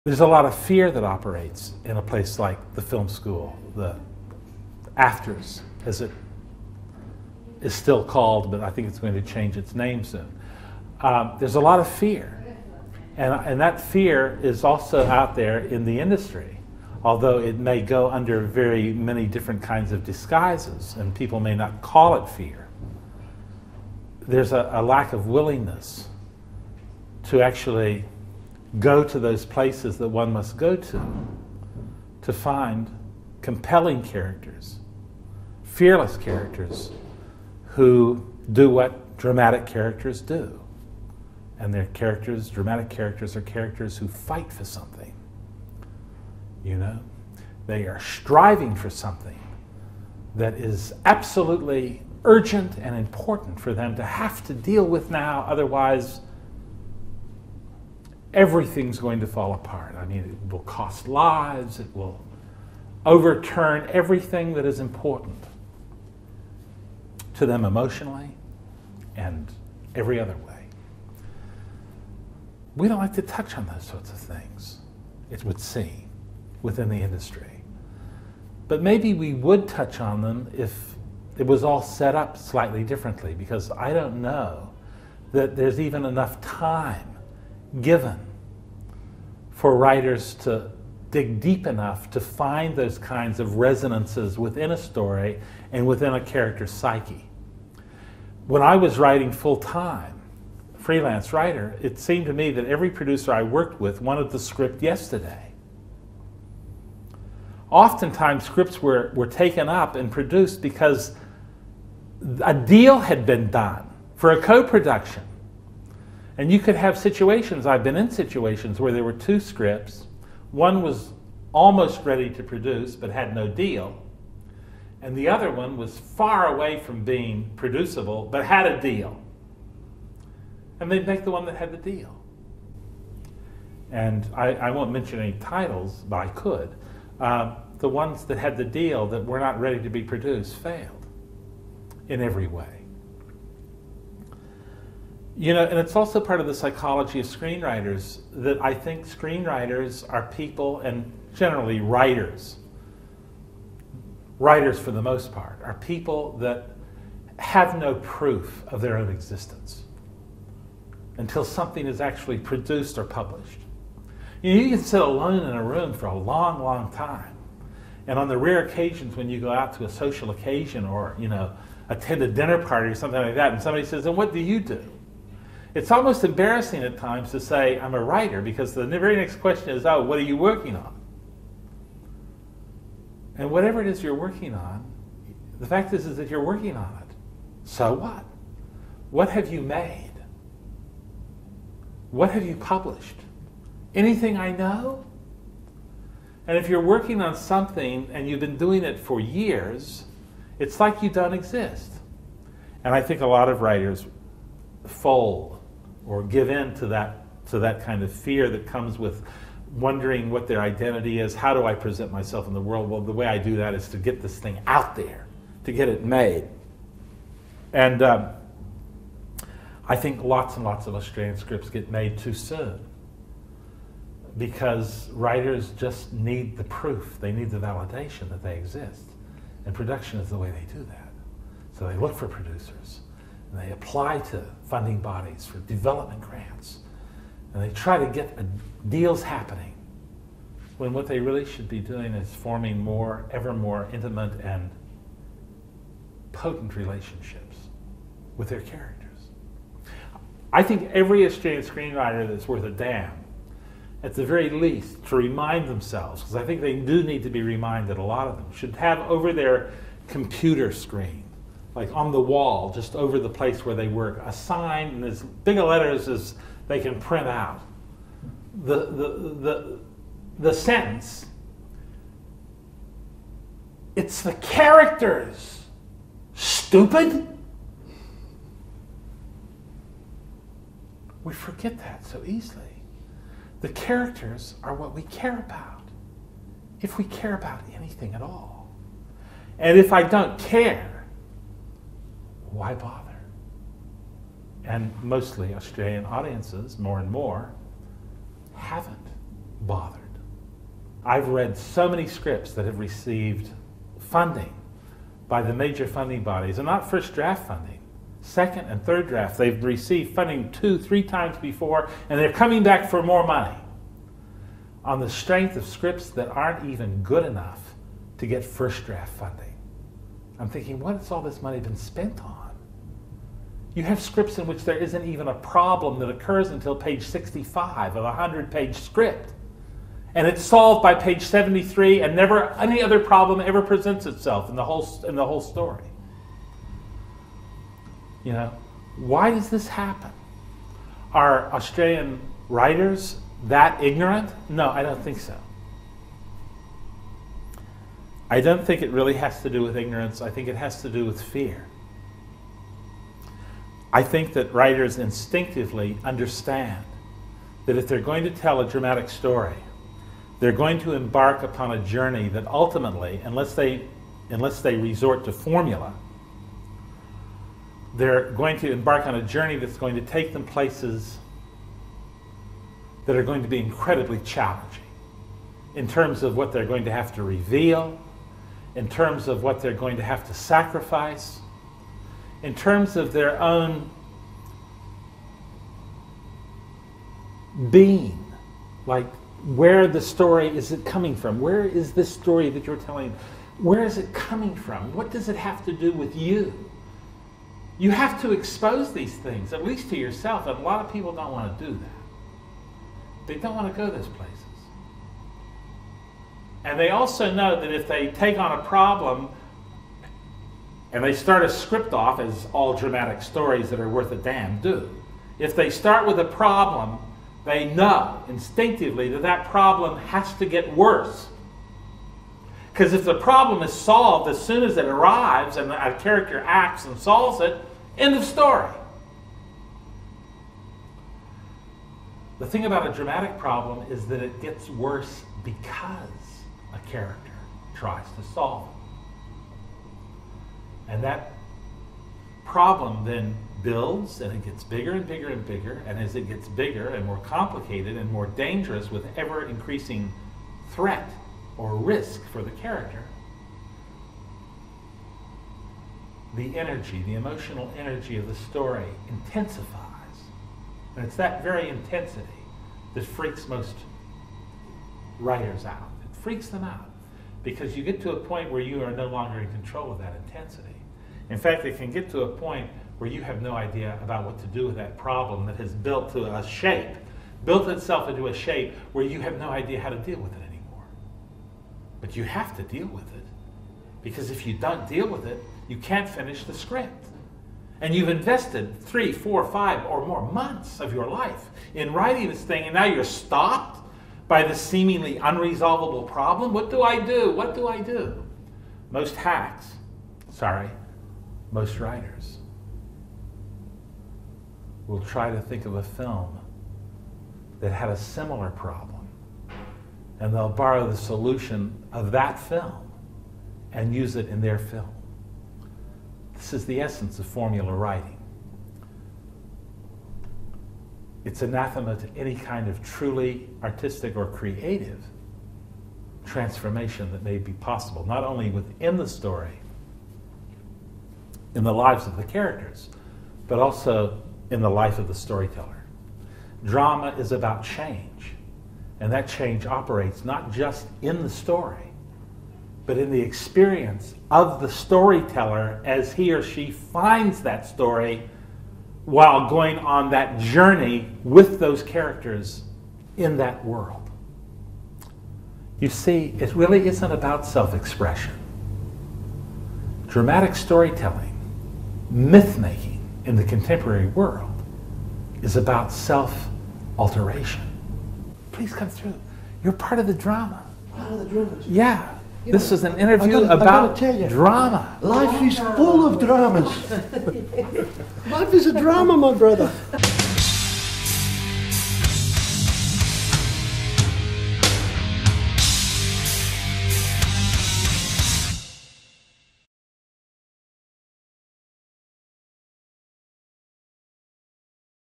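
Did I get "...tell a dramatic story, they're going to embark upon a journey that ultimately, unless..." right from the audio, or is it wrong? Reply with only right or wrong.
right.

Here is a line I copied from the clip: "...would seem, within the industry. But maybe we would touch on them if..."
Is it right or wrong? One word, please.
right.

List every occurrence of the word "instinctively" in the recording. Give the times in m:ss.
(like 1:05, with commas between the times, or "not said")
5:54, 6:58.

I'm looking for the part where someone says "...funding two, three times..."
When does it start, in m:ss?
5:10.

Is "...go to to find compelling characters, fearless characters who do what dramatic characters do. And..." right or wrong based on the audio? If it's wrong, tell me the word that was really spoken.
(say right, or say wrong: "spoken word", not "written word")
right.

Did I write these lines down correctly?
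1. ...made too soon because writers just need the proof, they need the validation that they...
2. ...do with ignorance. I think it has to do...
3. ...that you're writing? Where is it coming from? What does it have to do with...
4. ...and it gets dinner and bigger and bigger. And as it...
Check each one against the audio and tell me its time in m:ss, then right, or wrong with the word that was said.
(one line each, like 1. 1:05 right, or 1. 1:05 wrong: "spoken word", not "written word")
1. 3:41 right
2. 5:49 right
3. 6:32 wrong: "telling", not "writing"
4. 7:24 wrong: "bigger", not "dinner".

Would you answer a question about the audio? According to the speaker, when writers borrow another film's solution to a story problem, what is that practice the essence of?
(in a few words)
formula writing.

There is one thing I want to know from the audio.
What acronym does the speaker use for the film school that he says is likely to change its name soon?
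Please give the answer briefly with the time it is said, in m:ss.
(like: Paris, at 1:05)
AFTRS, at 0:04.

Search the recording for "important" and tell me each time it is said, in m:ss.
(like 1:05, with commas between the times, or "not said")
0:52, 1:04.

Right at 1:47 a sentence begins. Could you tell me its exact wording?
Oftentimes, scripts were, were taken up and produced because a deal had been done for a co production.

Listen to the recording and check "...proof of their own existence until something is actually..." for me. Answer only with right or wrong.
right.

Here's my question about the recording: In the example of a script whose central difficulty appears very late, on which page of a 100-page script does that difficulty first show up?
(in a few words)
65.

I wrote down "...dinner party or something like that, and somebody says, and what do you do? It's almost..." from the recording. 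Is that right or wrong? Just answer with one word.
right.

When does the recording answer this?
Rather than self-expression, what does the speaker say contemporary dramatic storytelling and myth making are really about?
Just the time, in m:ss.
9:25.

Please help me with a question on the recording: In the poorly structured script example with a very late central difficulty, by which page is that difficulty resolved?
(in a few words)
73.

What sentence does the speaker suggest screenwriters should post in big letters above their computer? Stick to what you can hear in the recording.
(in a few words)
It's the characters, stupid.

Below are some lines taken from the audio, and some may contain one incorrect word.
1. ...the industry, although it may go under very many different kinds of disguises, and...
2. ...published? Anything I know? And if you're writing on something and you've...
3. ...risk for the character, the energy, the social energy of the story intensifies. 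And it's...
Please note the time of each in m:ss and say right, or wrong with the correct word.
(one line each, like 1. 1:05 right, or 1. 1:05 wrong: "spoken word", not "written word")
1. 0:15 right
2. 3:12 wrong: "working", not "writing"
3. 7:31 wrong: "emotional", not "social".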